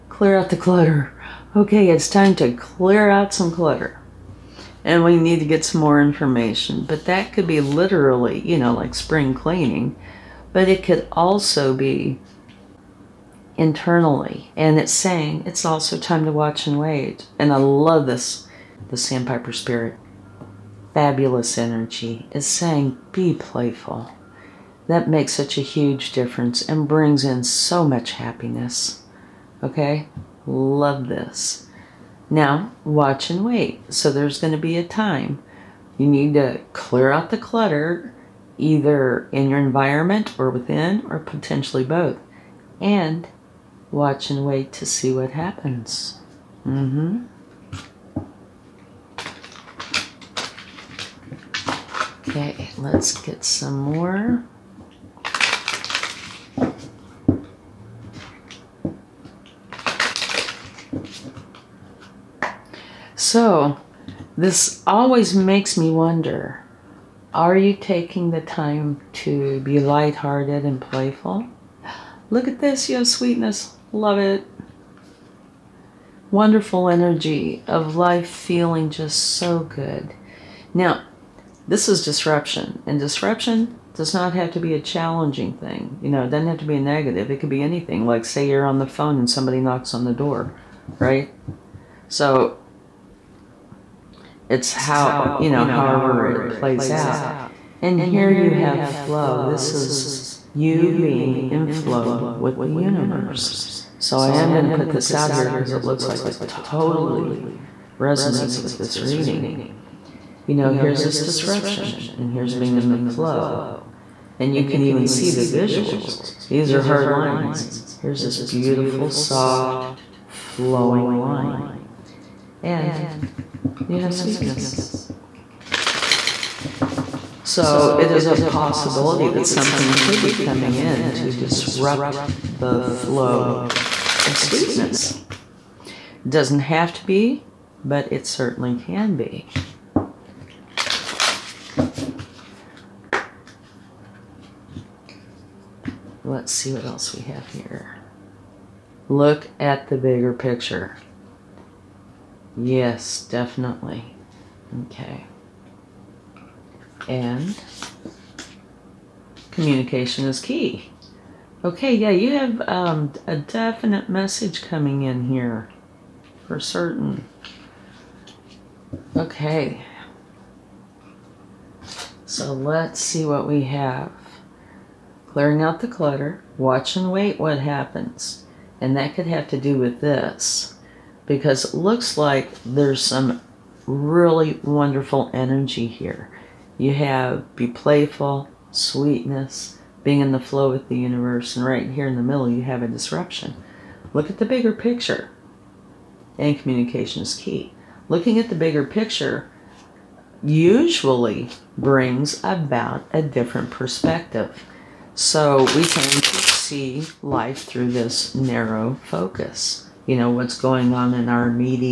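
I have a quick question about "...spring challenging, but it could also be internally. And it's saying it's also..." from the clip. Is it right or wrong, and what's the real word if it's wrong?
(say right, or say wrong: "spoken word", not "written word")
wrong: "cleaning", not "challenging".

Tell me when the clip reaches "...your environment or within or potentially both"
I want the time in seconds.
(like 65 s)
39 s.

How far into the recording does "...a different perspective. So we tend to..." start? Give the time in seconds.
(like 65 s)
203 s.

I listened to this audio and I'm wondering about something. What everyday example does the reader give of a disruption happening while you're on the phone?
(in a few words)
Somebody knocks on the door.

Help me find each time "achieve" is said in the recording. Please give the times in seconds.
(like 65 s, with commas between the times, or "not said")
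not said.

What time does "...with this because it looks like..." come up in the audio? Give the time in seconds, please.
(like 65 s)
179 s.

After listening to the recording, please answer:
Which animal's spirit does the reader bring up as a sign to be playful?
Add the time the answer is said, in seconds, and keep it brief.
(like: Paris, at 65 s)
Sandpiper, at 18 s.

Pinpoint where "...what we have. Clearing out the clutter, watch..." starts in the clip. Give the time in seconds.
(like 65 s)
173 s.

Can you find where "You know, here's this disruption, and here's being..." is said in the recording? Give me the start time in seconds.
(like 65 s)
110 s.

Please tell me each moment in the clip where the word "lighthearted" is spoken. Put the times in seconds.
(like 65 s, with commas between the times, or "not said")
69 s.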